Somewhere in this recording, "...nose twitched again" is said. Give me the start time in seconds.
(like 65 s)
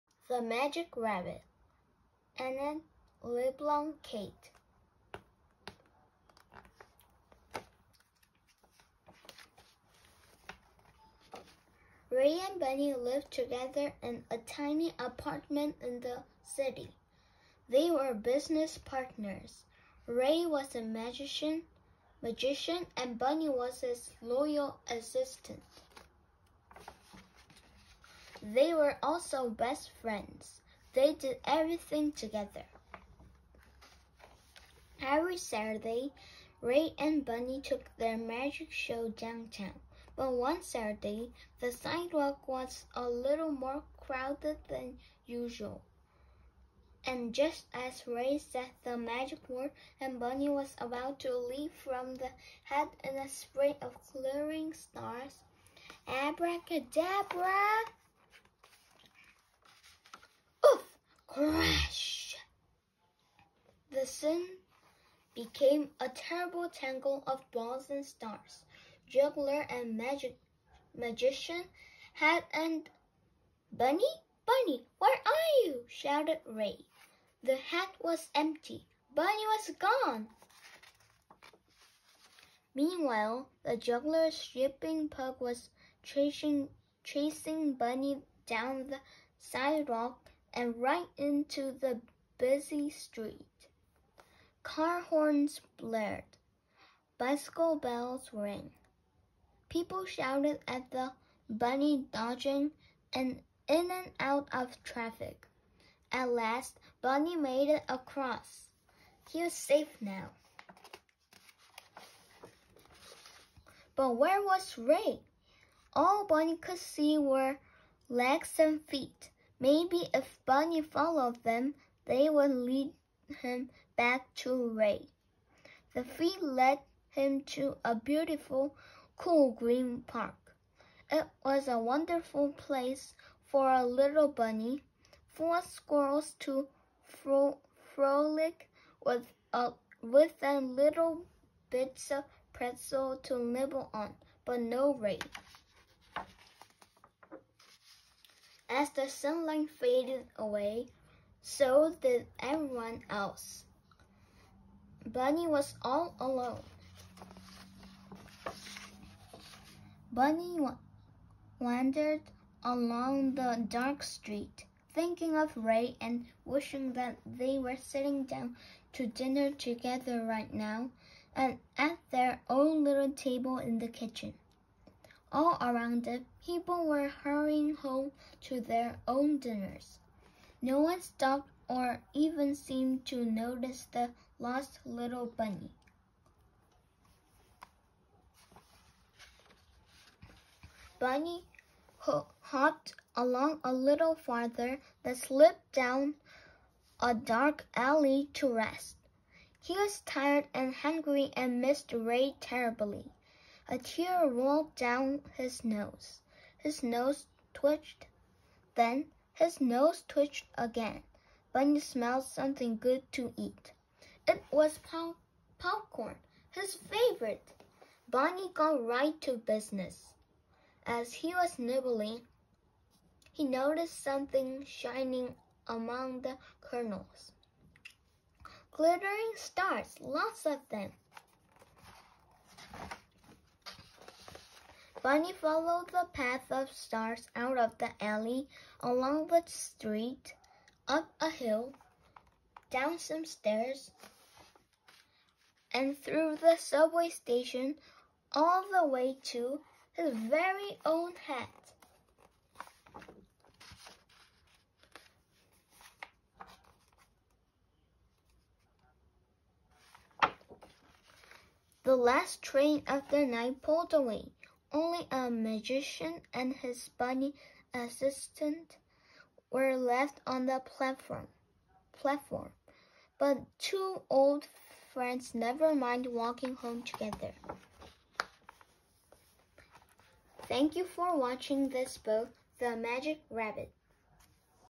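209 s.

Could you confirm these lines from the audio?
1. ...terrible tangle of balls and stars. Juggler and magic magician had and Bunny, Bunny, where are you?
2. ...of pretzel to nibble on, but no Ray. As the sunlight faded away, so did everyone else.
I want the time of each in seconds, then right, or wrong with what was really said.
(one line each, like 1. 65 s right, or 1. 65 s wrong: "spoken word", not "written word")
1. 66 s right
2. 142 s right.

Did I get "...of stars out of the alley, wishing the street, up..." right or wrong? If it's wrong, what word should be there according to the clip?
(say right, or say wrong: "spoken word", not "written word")
wrong: "along", not "wishing".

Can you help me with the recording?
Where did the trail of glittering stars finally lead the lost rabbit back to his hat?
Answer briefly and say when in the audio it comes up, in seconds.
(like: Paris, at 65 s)
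Subway station, at 246 s.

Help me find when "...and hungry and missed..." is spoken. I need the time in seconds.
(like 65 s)
200 s.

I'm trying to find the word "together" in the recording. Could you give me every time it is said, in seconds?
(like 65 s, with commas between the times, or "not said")
13 s, 32 s, 169 s, 276 s.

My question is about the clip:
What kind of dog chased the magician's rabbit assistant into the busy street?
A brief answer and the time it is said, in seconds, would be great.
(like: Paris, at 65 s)
Pug, at 85 s.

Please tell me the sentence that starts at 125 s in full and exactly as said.
The three led him to a beautiful, cool green park.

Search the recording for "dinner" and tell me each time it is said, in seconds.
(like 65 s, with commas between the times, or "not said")
169 s, 179 s.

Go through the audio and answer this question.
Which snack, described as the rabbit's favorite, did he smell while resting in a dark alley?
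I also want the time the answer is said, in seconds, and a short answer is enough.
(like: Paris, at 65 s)
Popcorn, at 215 s.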